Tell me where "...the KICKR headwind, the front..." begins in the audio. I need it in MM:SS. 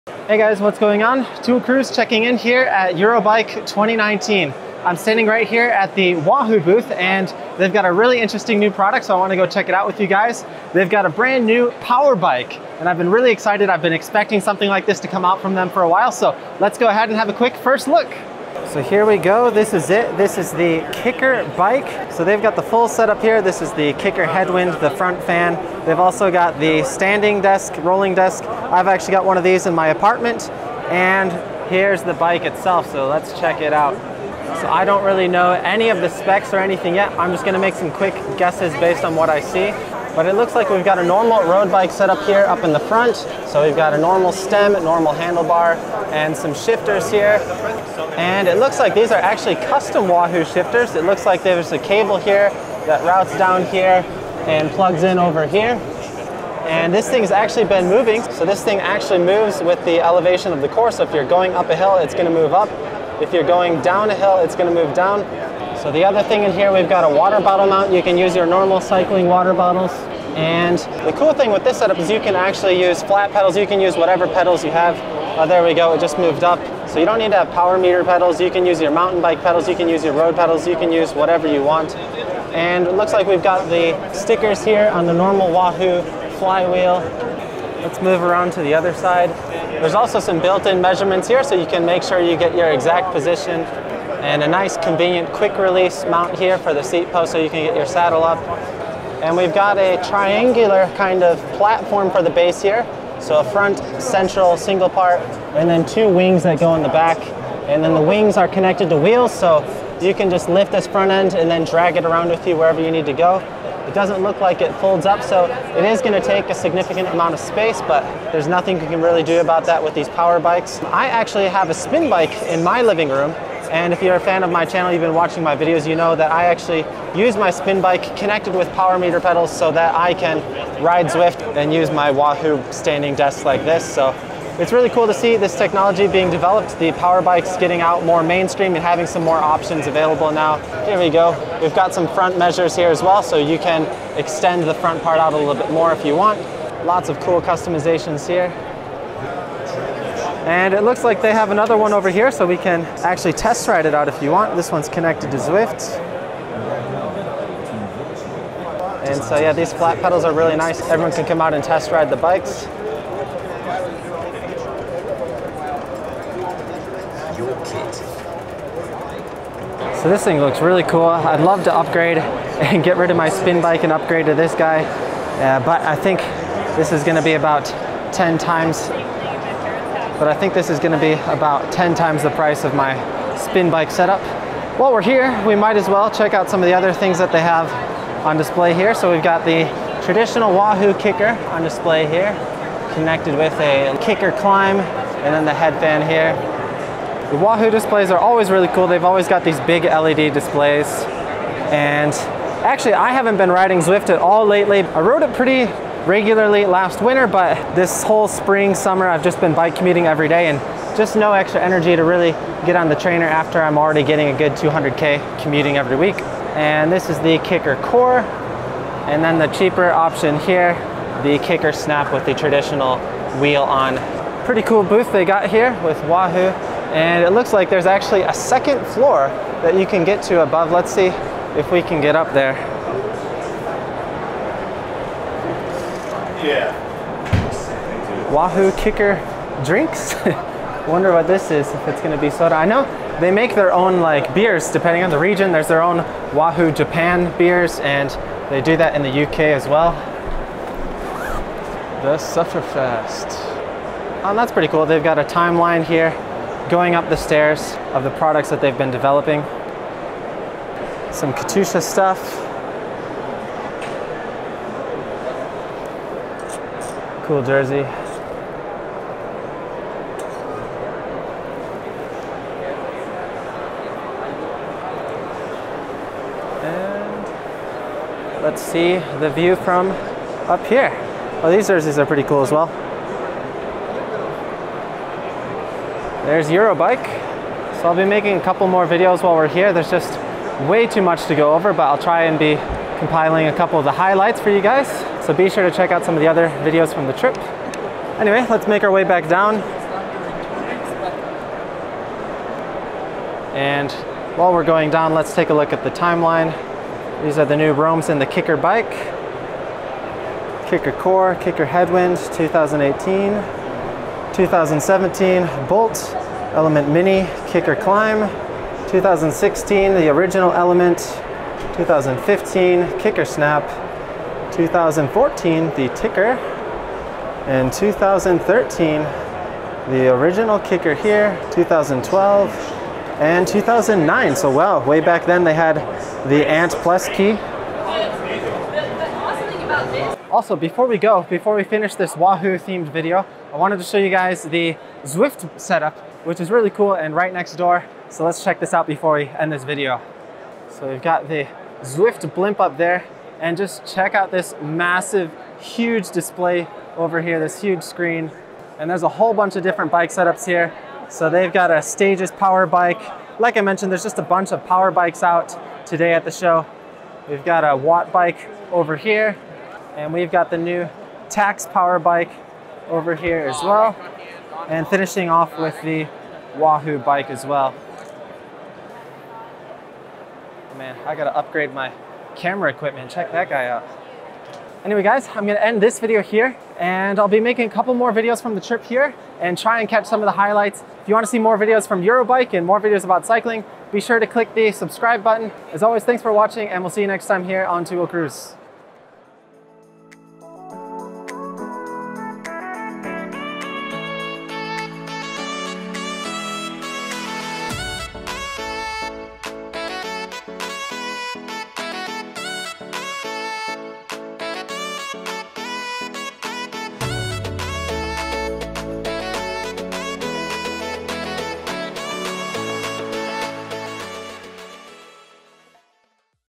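00:23.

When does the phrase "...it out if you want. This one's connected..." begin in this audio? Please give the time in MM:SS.
02:33.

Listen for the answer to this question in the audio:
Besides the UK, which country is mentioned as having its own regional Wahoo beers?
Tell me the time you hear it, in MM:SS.
04:06.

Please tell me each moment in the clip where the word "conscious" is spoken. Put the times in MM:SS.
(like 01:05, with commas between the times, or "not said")
not said.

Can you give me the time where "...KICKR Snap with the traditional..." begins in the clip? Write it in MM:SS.
03:41.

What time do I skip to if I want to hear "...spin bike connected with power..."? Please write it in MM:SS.
02:07.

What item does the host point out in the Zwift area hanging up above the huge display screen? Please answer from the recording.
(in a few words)
Zwift blimp.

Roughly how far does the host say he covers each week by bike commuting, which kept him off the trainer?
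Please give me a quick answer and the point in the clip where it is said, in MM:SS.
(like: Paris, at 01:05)
200K, at 03:34.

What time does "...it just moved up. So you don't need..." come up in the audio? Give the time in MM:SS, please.
01:15.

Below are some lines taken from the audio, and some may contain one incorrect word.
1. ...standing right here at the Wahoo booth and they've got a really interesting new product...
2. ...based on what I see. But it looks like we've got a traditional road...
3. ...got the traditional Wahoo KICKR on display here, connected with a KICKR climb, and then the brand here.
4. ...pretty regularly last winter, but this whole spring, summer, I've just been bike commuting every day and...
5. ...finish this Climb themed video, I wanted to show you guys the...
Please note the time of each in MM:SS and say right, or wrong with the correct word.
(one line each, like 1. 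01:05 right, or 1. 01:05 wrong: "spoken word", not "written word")
1. 00:04 right
2. 00:38 wrong: "normal", not "traditional"
3. 03:09 wrong: "headband", not "brand"
4. 03:25 right
5. 05:41 wrong: "Wahoo", not "Climb".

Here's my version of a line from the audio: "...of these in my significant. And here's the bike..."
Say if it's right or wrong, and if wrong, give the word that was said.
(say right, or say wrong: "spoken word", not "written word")
wrong: "apartment", not "significant".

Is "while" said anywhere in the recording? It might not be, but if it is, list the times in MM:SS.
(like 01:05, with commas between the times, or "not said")
00:15, 03:04, 04:49, 05:04.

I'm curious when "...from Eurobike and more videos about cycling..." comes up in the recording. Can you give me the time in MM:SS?
06:31.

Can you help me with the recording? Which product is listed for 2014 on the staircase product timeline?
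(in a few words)
TICKR.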